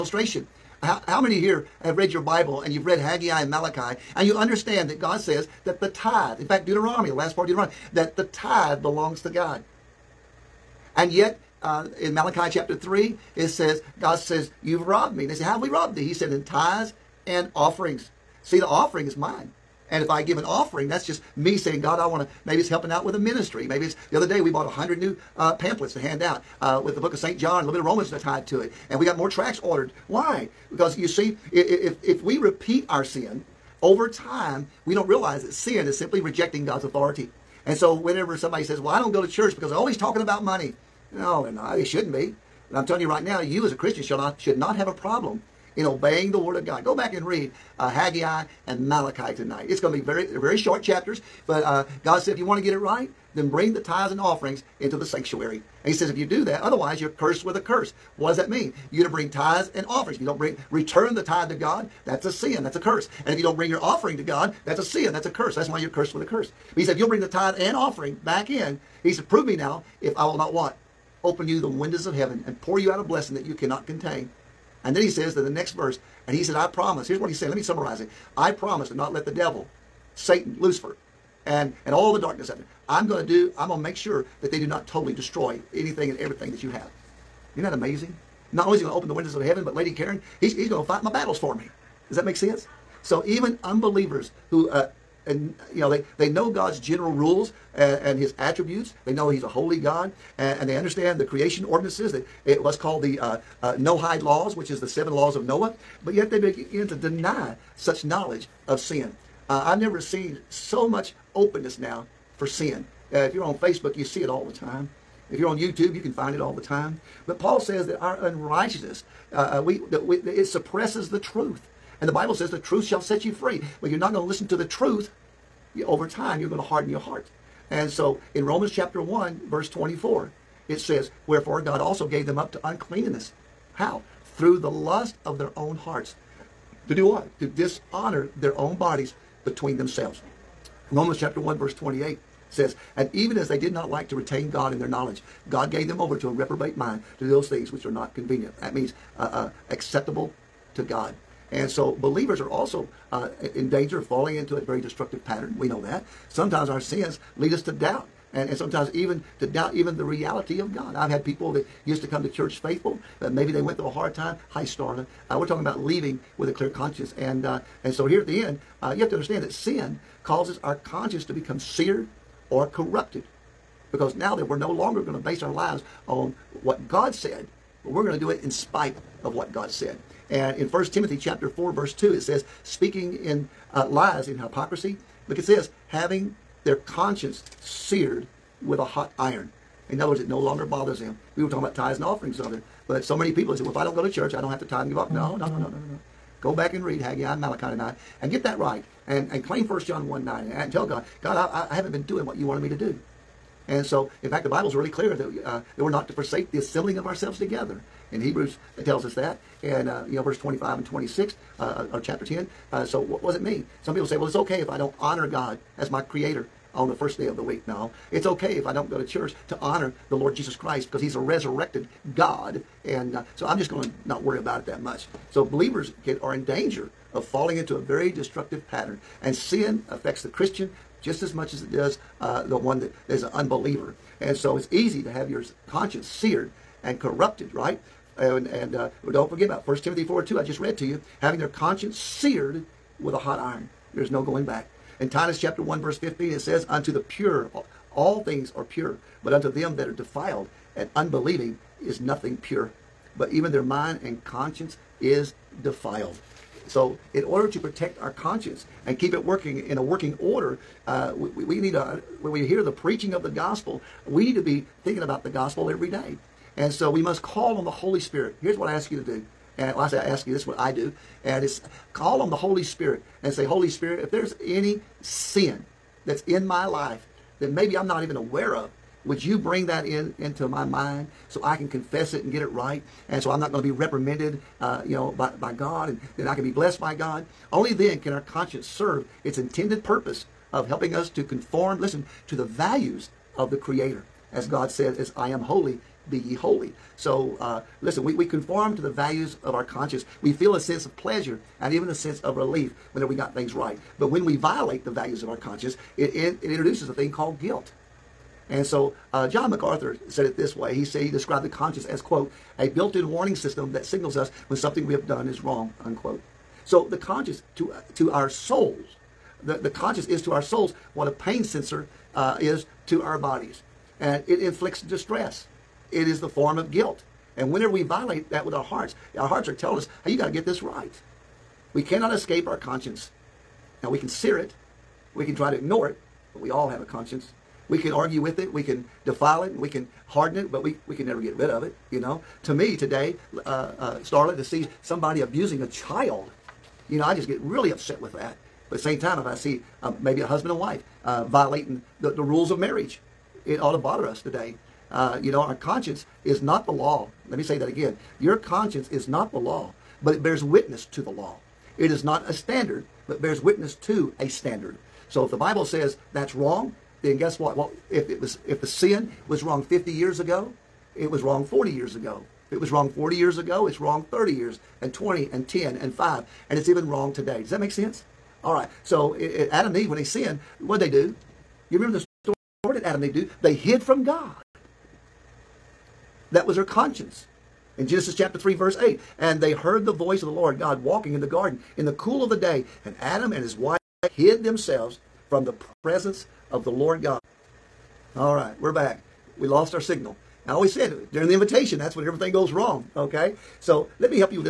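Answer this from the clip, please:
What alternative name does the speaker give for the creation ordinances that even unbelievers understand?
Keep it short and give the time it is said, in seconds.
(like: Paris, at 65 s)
Noahide laws, at 103 s.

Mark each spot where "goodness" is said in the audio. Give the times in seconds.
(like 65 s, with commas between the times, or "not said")
not said.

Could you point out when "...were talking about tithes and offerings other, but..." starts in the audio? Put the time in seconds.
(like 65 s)
191 s.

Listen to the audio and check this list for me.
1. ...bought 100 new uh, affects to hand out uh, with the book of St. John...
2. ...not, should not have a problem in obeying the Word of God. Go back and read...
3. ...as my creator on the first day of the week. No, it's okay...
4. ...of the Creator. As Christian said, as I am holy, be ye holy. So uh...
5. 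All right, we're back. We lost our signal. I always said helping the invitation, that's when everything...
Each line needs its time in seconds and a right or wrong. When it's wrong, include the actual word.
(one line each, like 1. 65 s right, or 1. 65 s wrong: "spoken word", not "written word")
1. 24 s wrong: "pamphlets", not "affects"
2. 44 s right
3. 215 s right
4. 293 s wrong: "God", not "Christian"
5. 398 s wrong: "during", not "helping".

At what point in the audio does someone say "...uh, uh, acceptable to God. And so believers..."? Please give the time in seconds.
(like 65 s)
149 s.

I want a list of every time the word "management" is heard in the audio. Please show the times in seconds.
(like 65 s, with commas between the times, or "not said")
not said.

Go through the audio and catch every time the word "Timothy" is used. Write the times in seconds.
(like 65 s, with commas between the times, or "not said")
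180 s, 239 s.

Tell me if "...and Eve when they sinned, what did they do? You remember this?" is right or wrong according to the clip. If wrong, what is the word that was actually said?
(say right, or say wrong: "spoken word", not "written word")
right.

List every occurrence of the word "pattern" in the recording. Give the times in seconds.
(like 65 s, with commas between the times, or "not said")
155 s, 228 s.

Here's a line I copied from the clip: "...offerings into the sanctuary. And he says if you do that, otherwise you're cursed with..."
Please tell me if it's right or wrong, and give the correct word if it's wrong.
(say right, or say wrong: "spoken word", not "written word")
right.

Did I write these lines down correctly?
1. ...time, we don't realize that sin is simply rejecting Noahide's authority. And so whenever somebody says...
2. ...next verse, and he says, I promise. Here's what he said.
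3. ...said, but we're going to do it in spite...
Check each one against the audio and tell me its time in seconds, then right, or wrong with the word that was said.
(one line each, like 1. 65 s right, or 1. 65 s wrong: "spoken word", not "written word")
1. 34 s wrong: "God", not "Noahide"
2. 75 s right
3. 177 s right.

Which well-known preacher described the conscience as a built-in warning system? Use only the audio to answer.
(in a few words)
John MacArthur.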